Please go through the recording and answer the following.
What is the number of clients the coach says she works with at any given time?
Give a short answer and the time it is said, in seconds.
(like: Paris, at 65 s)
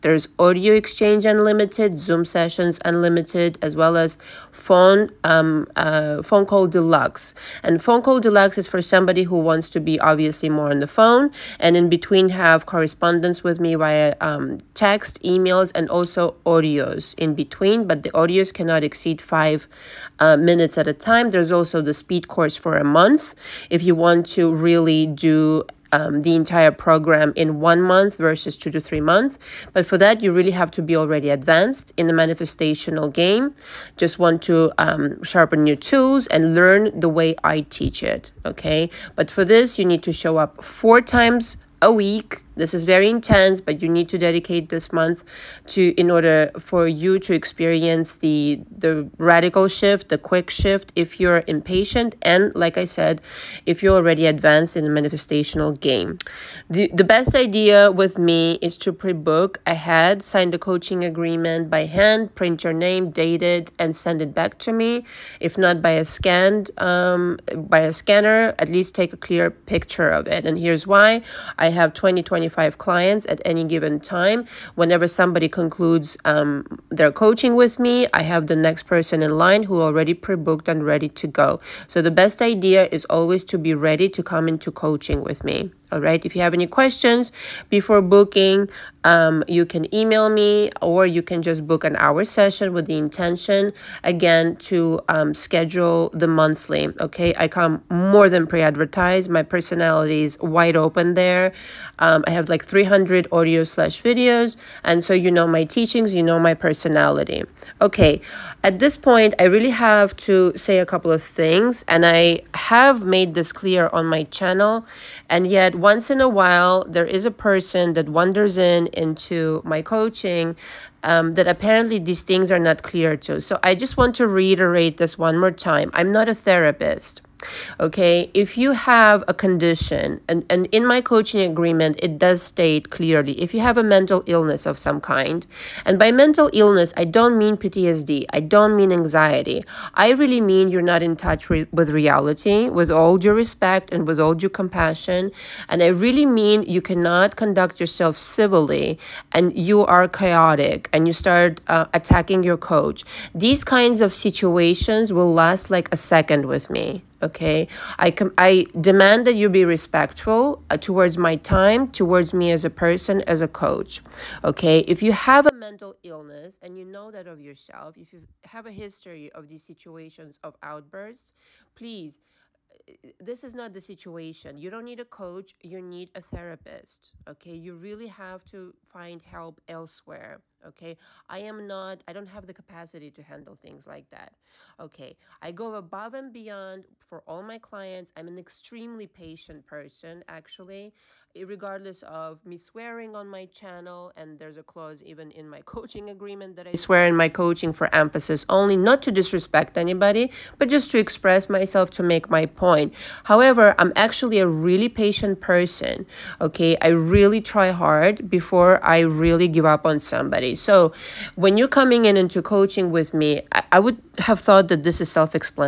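25, at 72 s.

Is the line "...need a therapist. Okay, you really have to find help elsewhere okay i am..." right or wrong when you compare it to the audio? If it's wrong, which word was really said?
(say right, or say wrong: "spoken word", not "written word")
right.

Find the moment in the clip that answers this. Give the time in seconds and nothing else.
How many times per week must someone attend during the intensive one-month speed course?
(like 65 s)
40 s.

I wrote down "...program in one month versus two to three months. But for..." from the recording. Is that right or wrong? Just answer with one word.
right.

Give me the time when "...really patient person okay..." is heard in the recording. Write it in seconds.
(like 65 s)
204 s.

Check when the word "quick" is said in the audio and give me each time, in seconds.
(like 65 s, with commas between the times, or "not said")
50 s.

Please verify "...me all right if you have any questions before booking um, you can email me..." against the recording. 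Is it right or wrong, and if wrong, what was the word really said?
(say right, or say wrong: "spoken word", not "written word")
right.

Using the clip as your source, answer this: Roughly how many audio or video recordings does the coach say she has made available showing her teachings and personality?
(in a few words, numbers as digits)
300.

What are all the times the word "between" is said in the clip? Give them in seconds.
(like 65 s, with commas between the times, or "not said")
11 s, 17 s.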